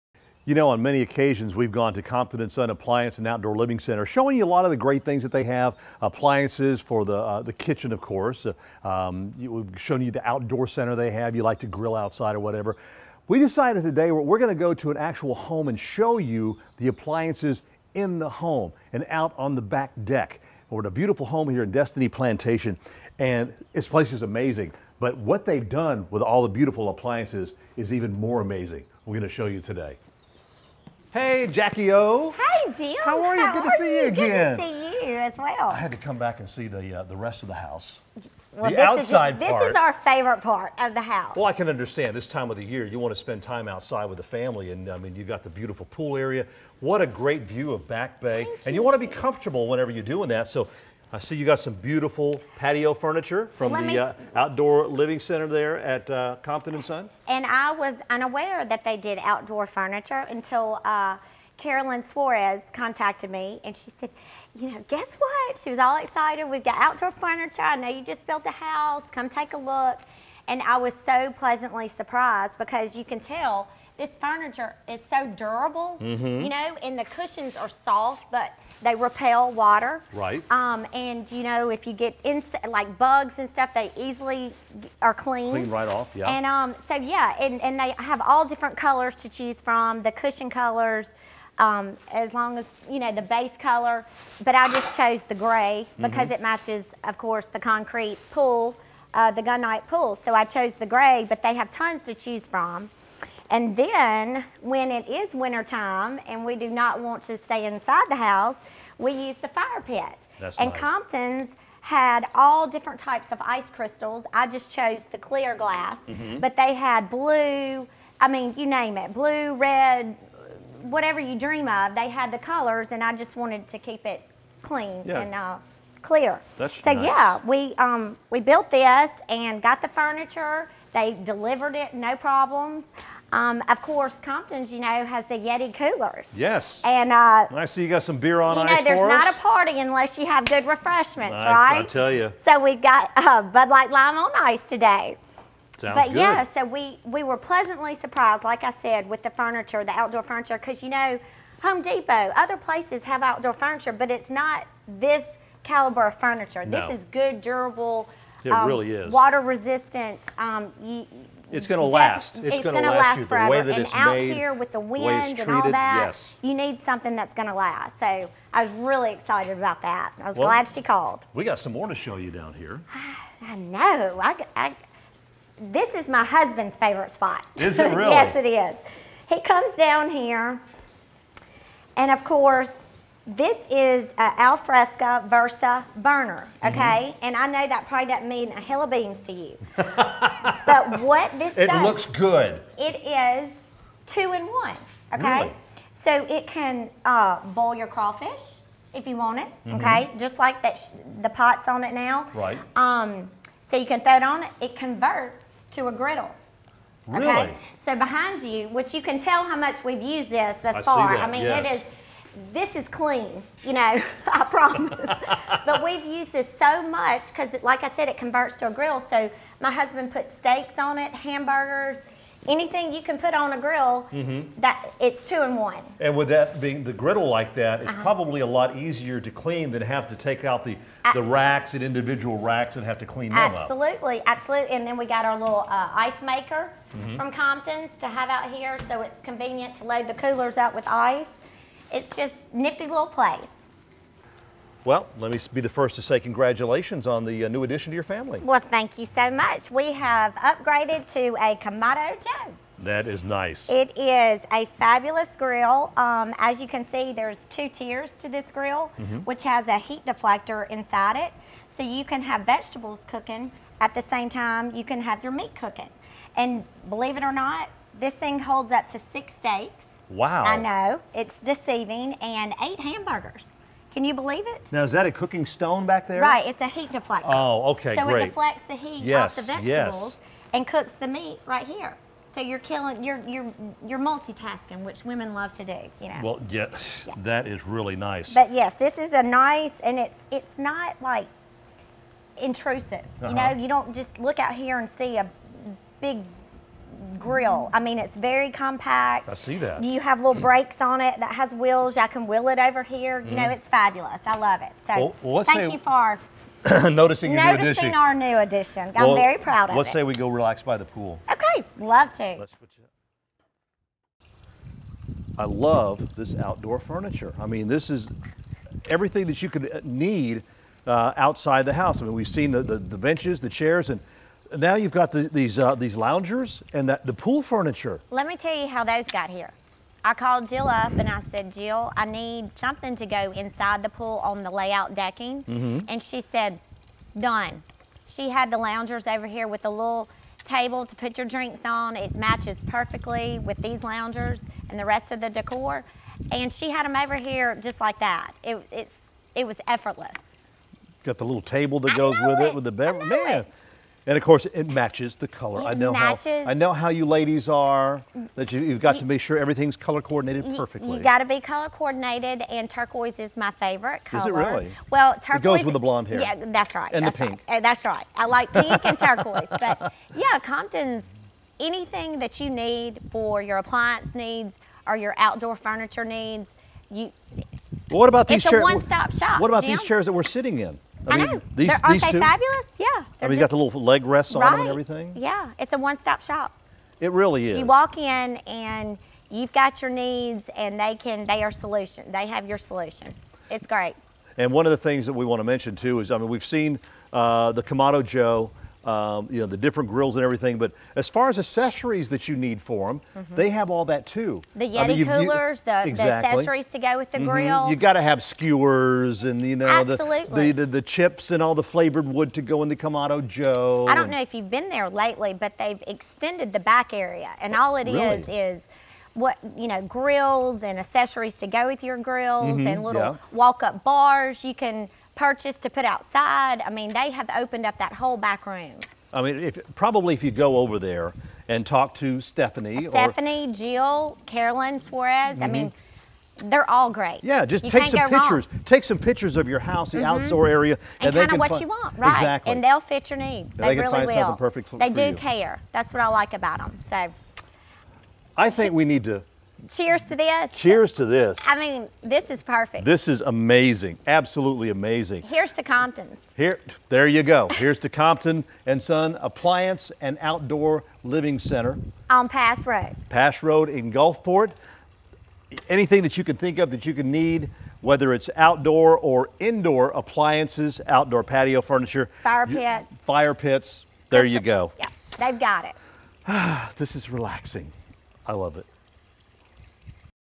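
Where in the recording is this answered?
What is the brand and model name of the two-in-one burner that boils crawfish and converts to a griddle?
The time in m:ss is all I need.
3:04.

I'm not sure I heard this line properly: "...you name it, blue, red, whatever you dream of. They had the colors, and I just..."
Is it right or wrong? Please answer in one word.
right.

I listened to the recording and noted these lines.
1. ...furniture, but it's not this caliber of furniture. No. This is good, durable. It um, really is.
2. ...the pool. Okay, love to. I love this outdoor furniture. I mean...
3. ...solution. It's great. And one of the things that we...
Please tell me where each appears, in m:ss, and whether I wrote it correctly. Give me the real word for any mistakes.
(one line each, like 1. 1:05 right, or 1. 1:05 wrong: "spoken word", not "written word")
1. 2:33 right
2. 5:10 right
3. 6:32 right.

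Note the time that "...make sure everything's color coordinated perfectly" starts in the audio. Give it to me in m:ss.
5:59.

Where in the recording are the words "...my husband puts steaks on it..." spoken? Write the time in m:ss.
3:39.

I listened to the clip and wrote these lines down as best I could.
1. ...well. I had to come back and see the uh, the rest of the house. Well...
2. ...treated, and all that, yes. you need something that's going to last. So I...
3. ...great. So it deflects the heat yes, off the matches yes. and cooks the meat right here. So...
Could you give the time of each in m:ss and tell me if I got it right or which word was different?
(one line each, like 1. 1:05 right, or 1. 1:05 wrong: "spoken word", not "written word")
1. 0:35 right
2. 2:45 right
3. 4:38 wrong: "vegetables", not "matches".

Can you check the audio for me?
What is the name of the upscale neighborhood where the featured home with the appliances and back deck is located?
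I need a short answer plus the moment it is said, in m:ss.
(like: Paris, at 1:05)
Destiny Plantation, at 0:21.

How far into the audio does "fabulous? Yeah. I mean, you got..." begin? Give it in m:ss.
6:22.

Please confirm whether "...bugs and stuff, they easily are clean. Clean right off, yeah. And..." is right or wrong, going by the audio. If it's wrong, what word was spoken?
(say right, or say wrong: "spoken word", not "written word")
right.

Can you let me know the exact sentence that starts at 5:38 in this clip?
She had the loungers over here with a little table to put your drinks on.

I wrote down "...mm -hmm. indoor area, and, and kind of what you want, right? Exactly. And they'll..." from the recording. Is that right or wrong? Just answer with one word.
wrong.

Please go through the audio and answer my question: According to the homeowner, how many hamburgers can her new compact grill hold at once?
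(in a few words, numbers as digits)
8.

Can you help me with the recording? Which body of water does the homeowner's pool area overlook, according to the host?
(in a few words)
Back Bay.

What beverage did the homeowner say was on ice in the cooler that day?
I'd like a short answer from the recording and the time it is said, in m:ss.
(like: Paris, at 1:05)
Bud Light Lime, at 2:23.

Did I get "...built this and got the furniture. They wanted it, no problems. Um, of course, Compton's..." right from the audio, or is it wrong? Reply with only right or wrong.
wrong.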